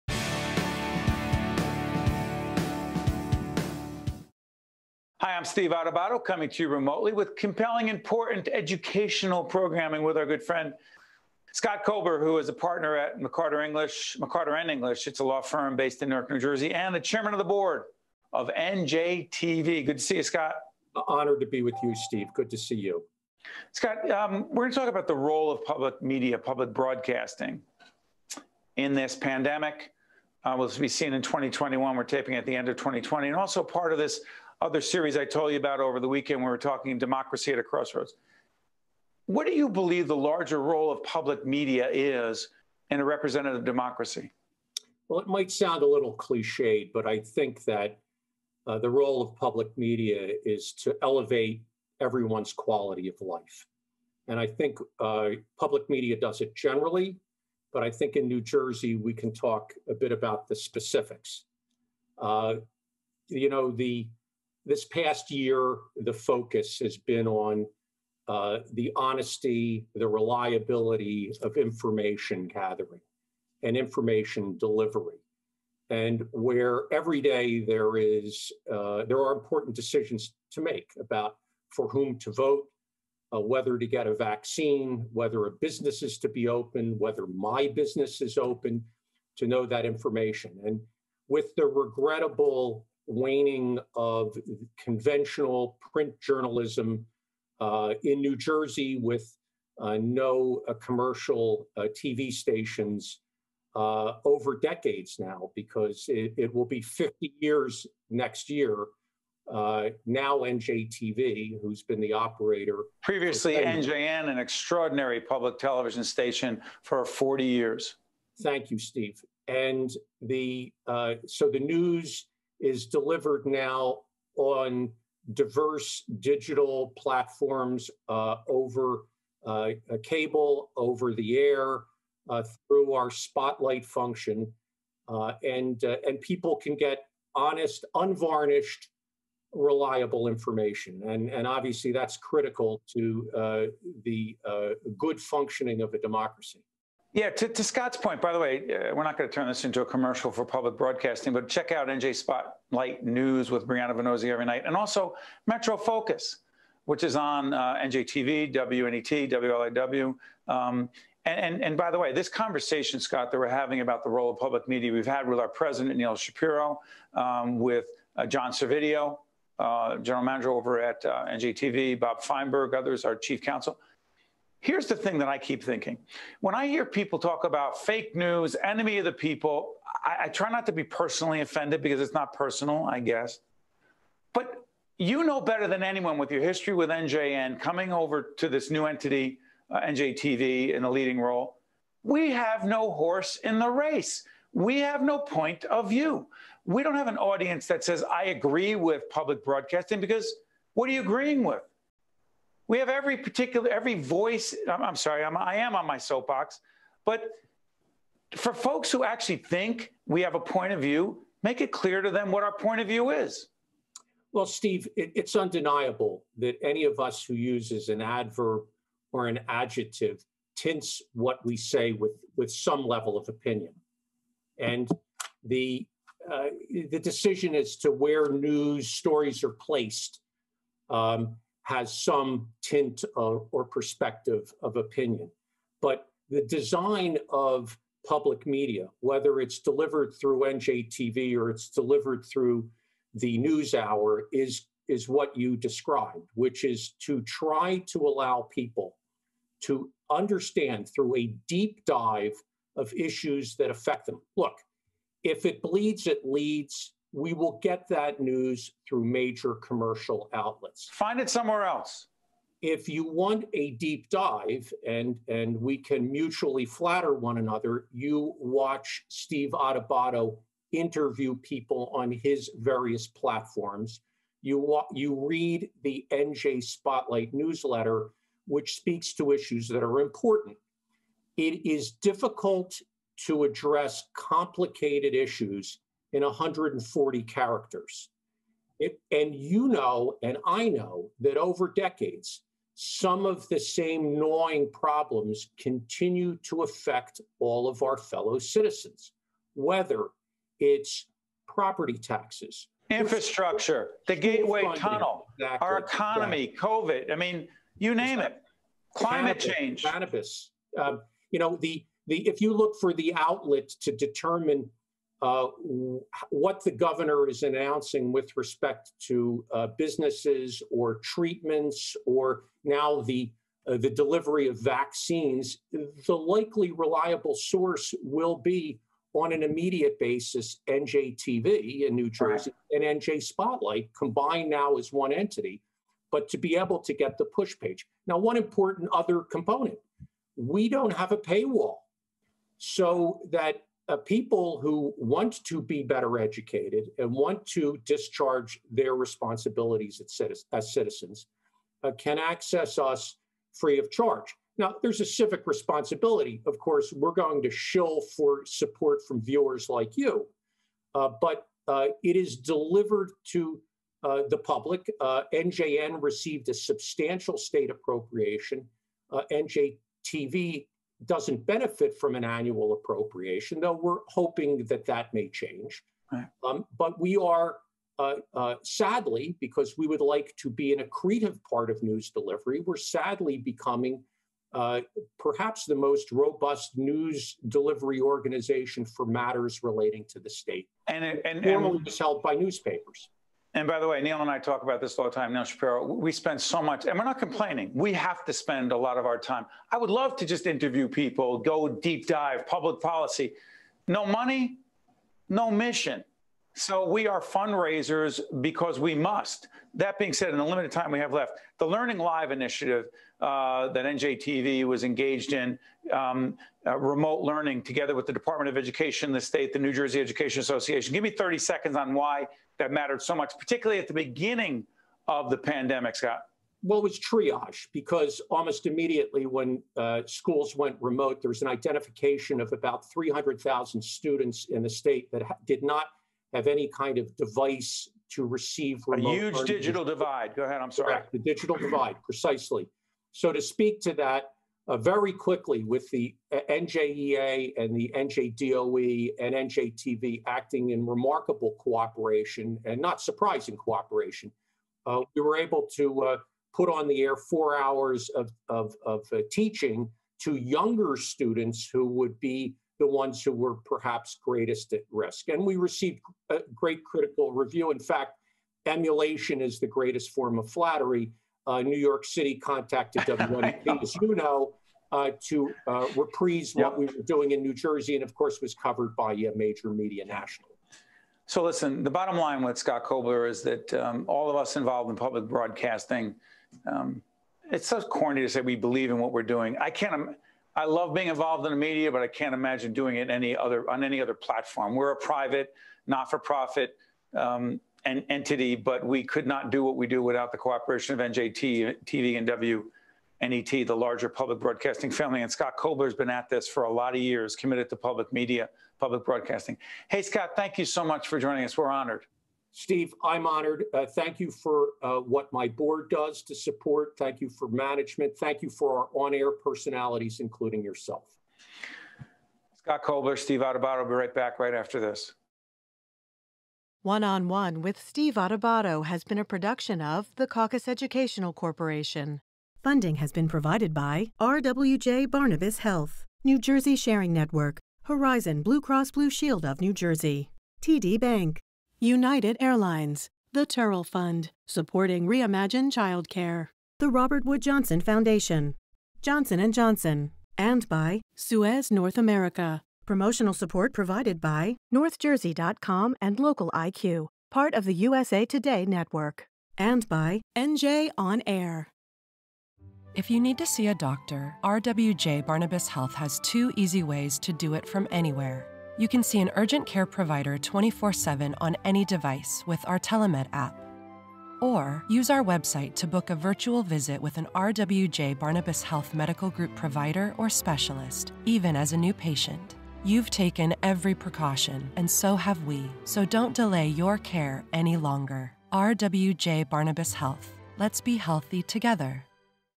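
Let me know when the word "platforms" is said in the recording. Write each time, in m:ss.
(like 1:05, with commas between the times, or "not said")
2:06, 4:33, 8:14.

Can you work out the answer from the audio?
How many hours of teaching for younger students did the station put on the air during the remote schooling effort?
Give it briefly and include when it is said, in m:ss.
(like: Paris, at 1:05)
4, at 7:37.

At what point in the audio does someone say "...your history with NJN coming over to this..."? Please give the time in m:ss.
3:06.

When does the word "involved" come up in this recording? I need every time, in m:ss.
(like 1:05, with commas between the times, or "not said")
8:04, 8:11.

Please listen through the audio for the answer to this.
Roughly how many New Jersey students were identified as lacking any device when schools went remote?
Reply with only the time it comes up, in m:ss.
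7:12.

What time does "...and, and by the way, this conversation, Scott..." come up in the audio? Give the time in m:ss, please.
2:41.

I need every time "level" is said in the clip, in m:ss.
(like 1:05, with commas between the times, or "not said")
3:42.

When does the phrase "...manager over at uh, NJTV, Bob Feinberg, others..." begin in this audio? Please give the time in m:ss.
2:50.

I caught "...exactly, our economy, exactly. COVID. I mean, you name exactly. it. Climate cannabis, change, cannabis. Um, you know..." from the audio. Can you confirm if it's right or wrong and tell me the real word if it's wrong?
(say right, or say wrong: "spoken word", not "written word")
right.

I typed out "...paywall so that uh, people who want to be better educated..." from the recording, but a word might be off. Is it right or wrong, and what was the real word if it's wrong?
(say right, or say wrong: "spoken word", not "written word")
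right.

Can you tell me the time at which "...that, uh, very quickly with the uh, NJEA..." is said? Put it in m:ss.
7:23.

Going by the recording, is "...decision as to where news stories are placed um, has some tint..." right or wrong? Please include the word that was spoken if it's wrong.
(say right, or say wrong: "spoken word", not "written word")
right.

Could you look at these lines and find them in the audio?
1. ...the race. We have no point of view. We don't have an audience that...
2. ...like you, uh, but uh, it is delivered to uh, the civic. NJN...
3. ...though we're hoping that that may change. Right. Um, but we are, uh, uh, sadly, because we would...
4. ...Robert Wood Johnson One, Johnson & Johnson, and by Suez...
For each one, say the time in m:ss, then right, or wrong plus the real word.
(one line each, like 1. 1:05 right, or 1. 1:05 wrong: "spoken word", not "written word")
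1. 3:13 right
2. 5:59 wrong: "public", not "civic"
3. 6:13 right
4. 9:06 wrong: "Foundation", not "One".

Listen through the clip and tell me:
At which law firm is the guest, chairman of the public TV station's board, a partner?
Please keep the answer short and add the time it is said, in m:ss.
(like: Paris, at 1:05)
McCarter English, at 0:13.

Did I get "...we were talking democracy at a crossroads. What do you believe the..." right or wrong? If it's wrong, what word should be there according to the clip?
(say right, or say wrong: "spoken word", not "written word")
right.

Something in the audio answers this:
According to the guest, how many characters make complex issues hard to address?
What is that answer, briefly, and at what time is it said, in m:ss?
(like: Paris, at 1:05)
140, at 4:46.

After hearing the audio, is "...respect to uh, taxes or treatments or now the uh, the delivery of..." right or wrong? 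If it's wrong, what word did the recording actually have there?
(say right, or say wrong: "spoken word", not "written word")
wrong: "businesses", not "taxes".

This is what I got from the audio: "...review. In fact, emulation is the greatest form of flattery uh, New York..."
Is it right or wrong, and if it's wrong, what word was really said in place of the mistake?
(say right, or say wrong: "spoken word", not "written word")
right.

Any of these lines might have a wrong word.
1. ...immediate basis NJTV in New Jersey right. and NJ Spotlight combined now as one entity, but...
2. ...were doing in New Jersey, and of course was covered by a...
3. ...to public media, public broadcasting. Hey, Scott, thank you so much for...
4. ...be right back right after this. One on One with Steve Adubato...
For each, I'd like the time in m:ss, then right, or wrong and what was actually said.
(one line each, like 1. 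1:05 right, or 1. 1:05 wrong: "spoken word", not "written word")
1. 5:29 right
2. 7:56 right
3. 8:27 right
4. 8:43 right.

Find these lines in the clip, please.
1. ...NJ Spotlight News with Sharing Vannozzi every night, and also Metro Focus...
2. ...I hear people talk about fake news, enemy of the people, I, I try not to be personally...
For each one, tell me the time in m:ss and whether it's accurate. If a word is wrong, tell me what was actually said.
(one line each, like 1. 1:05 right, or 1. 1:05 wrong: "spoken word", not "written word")
1. 2:31 wrong: "Briana", not "Sharing"
2. 2:56 right.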